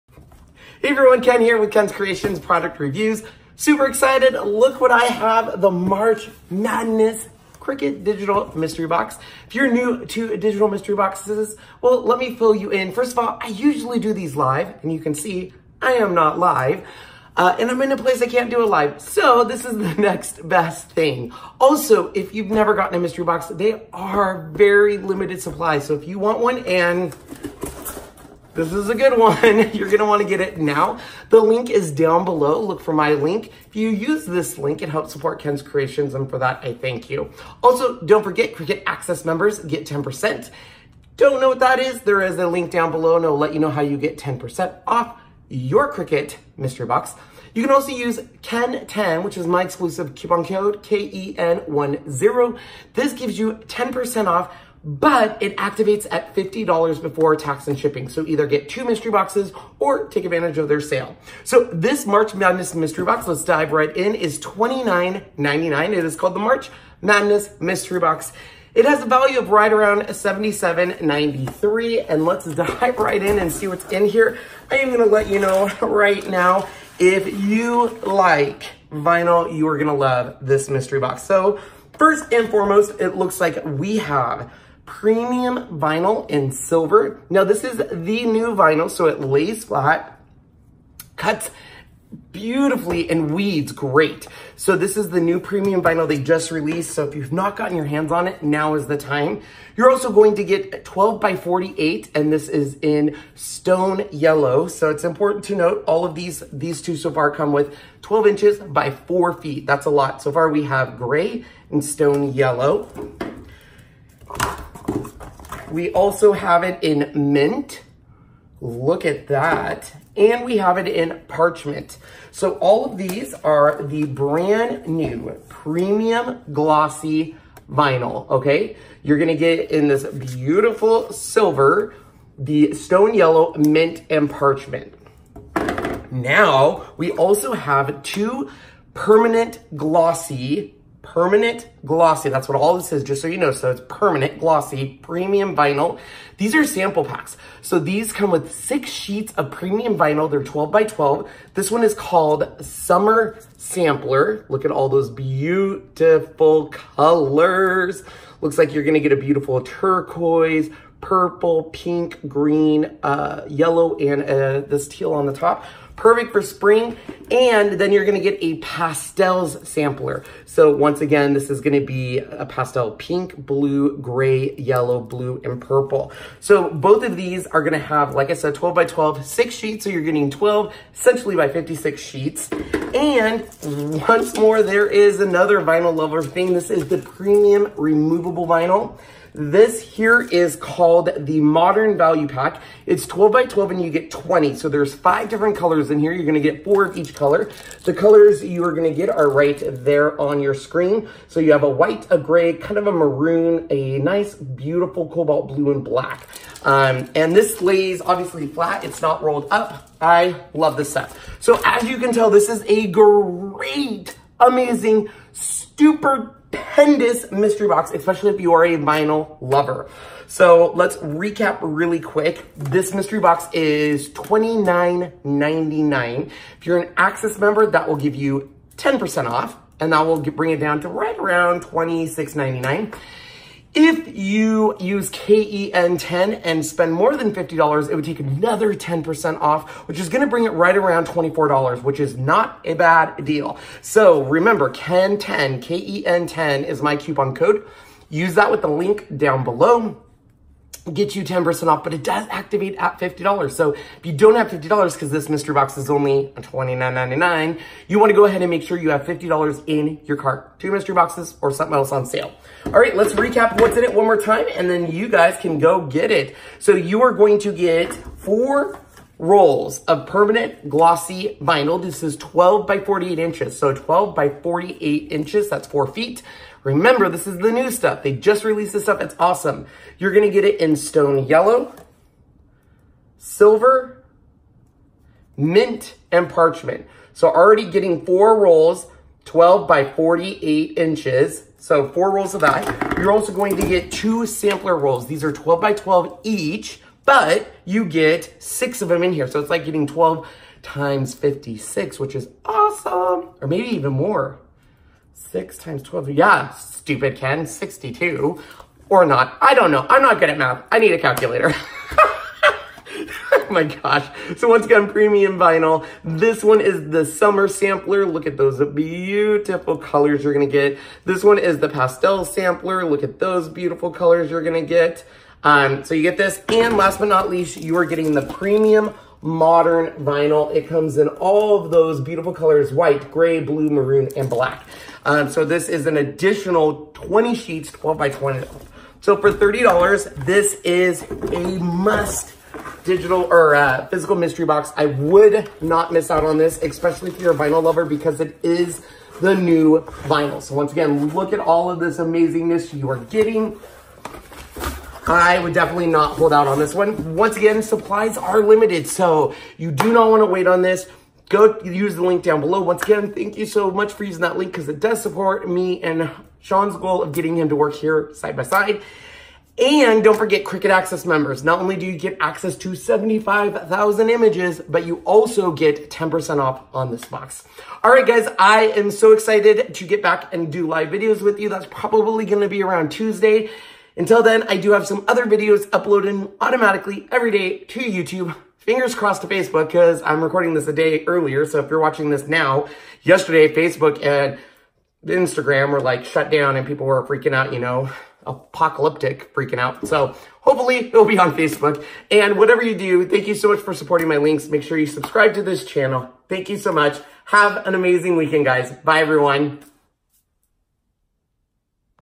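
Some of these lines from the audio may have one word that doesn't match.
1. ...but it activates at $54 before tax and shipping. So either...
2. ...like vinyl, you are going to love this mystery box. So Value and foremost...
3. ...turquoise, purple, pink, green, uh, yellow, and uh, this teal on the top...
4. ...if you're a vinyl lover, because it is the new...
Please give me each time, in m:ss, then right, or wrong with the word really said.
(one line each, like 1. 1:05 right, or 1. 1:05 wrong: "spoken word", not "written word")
1. 0:54 wrong: "50", not "54"
2. 1:18 wrong: "First", not "Value"
3. 2:39 right
4. 5:47 right.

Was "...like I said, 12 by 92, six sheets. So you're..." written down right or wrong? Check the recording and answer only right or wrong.
wrong.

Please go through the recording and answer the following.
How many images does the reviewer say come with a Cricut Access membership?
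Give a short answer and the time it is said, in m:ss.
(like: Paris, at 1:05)
75,000, at 6:12.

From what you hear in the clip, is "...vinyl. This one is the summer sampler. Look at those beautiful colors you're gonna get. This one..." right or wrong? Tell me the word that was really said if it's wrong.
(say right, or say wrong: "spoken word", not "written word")
right.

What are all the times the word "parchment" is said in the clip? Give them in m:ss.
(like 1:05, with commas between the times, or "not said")
2:01, 2:14, 4:46.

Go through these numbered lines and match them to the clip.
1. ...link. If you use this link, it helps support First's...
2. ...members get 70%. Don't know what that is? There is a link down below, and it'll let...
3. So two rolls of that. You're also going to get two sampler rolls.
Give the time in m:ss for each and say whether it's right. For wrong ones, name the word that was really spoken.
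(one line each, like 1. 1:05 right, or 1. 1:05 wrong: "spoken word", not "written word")
1. 0:33 wrong: "Ken", not "First"
2. 0:39 wrong: "10", not "70"
3. 4:51 wrong: "four", not "two".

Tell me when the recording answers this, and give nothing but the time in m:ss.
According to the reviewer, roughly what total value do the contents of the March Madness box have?
1:10.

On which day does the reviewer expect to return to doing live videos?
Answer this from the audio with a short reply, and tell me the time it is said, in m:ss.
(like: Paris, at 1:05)
Tuesday, at 6:22.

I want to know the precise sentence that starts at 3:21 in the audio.
So you have a white, a gray, kind of a maroon, a nice, beautiful cobalt blue and black.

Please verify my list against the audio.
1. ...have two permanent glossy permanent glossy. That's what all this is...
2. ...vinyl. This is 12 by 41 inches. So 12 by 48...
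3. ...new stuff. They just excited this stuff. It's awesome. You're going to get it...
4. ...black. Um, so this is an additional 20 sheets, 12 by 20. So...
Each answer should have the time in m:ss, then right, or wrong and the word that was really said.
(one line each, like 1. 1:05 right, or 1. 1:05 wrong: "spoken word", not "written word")
1. 2:17 right
2. 4:31 wrong: "48", not "41"
3. 4:37 wrong: "released", not "excited"
4. 5:34 right.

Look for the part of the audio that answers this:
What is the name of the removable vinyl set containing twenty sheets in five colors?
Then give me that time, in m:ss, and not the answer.
3:11.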